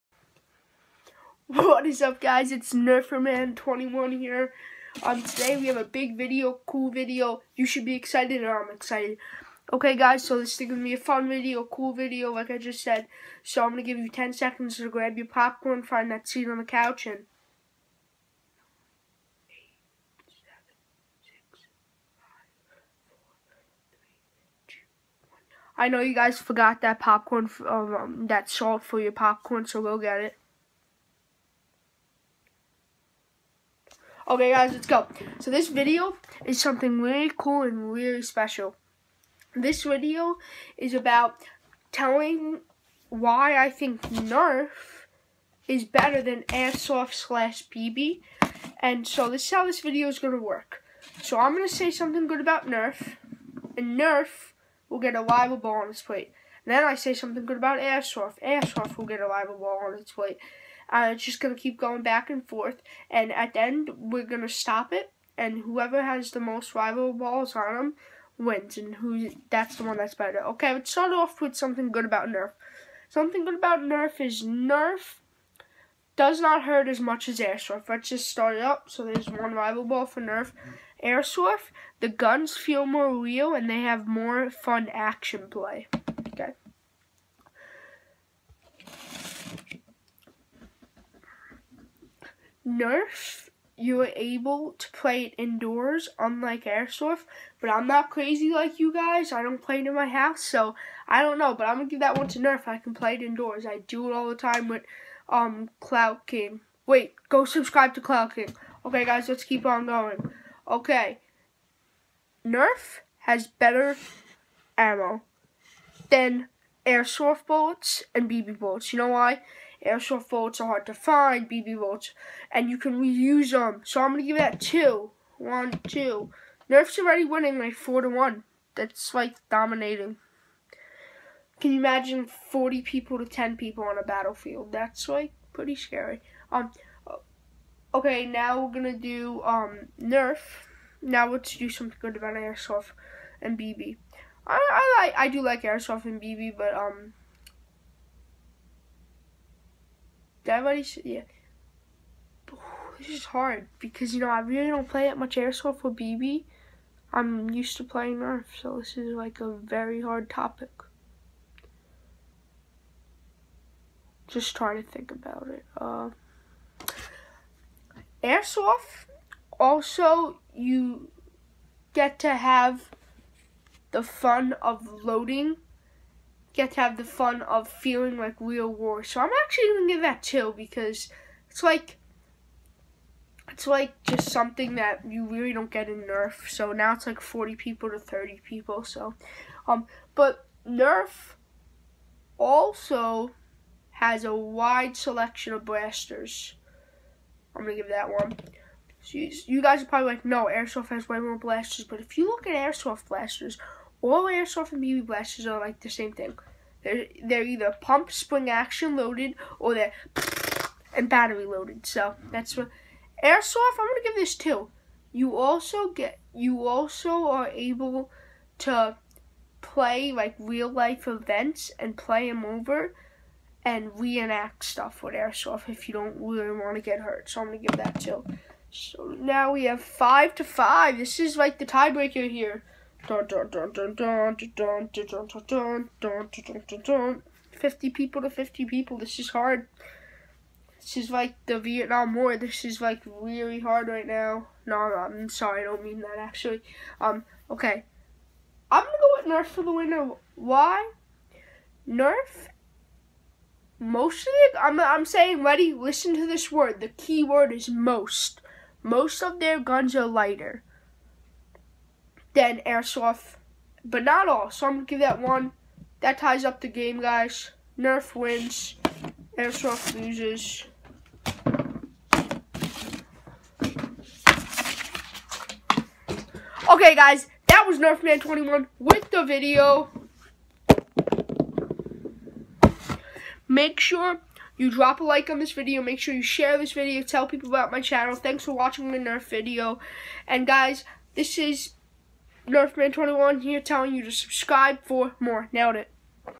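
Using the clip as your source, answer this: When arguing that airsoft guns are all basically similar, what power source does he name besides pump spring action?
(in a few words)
Battery.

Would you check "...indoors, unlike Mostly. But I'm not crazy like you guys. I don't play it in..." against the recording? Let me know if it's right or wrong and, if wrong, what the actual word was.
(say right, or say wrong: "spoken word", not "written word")
wrong: "Airsoft", not "Mostly".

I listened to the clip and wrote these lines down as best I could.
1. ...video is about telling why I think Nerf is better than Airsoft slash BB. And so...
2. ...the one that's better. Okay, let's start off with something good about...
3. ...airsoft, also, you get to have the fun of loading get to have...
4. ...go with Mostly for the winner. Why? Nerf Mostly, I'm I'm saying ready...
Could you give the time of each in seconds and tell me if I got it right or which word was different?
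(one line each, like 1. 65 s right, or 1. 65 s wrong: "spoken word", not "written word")
1. 39 s right
2. 69 s right
3. 168 s right
4. 249 s wrong: "Nerf", not "Mostly".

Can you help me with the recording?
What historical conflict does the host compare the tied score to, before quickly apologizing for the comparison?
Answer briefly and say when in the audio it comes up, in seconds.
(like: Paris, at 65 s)
Vietnam War, at 241 s.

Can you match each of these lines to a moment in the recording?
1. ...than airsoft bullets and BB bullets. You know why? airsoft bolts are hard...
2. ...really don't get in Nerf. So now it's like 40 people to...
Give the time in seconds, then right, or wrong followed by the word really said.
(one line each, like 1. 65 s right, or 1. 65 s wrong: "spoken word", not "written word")
1. 116 s right
2. 185 s right.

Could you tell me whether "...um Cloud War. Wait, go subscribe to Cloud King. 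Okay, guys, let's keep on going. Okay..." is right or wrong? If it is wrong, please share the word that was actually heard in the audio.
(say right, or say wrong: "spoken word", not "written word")
wrong: "King", not "War".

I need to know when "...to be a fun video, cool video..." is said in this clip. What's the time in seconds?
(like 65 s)
10 s.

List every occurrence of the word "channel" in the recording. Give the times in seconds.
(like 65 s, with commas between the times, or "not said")
287 s.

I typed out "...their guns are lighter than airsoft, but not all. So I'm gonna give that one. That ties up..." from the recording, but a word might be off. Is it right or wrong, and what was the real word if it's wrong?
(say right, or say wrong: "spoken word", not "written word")
right.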